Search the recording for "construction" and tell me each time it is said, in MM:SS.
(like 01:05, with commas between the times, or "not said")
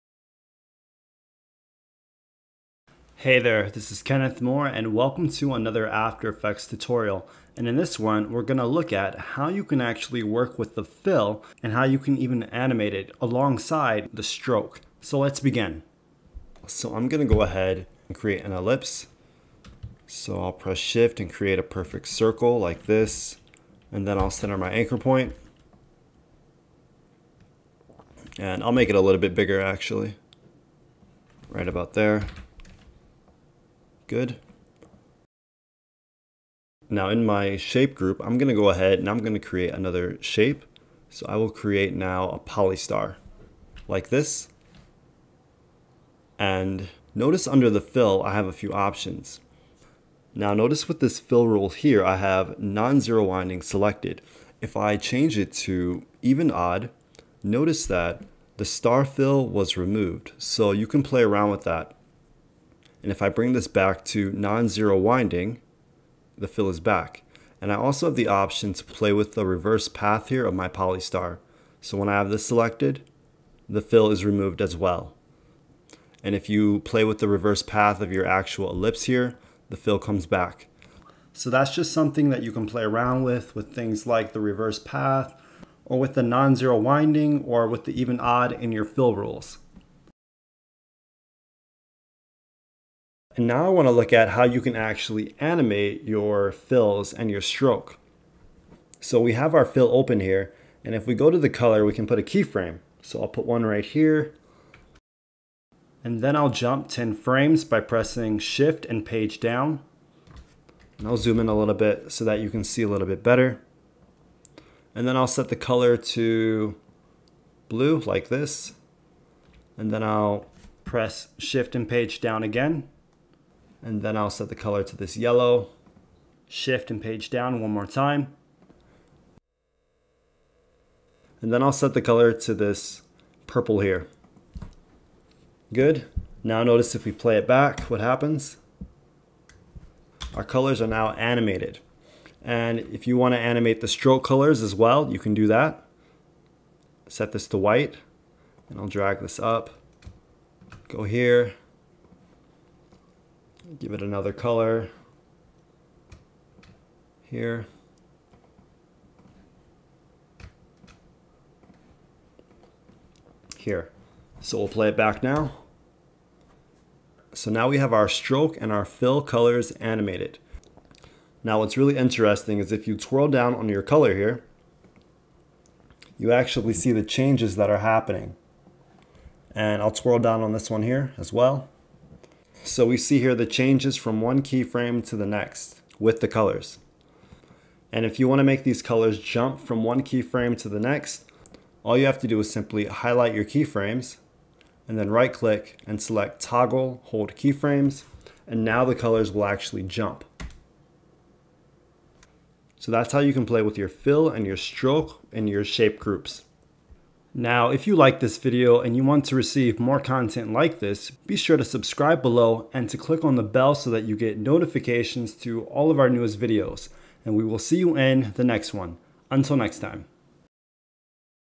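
not said.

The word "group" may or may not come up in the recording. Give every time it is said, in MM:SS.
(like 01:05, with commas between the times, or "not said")
00:37, 03:25.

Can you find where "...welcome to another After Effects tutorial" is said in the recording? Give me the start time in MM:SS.
00:04.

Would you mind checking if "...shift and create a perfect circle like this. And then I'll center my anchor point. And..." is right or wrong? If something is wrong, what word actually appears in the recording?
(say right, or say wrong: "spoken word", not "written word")
right.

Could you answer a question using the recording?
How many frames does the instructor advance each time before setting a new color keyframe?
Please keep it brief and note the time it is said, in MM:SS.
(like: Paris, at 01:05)
10, at 01:46.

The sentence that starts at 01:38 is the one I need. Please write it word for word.
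So we have our fill open here, and if we go to the color, we can put a keyframe.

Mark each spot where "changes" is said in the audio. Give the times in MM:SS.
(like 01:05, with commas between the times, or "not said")
00:54, 02:57, 03:03.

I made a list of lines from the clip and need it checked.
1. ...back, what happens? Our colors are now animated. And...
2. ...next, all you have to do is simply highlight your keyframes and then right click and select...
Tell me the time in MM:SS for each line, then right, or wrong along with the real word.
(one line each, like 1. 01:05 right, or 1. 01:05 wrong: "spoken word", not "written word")
1. 02:17 right
2. 03:10 right.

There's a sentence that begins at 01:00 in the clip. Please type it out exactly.
So you can play around with that.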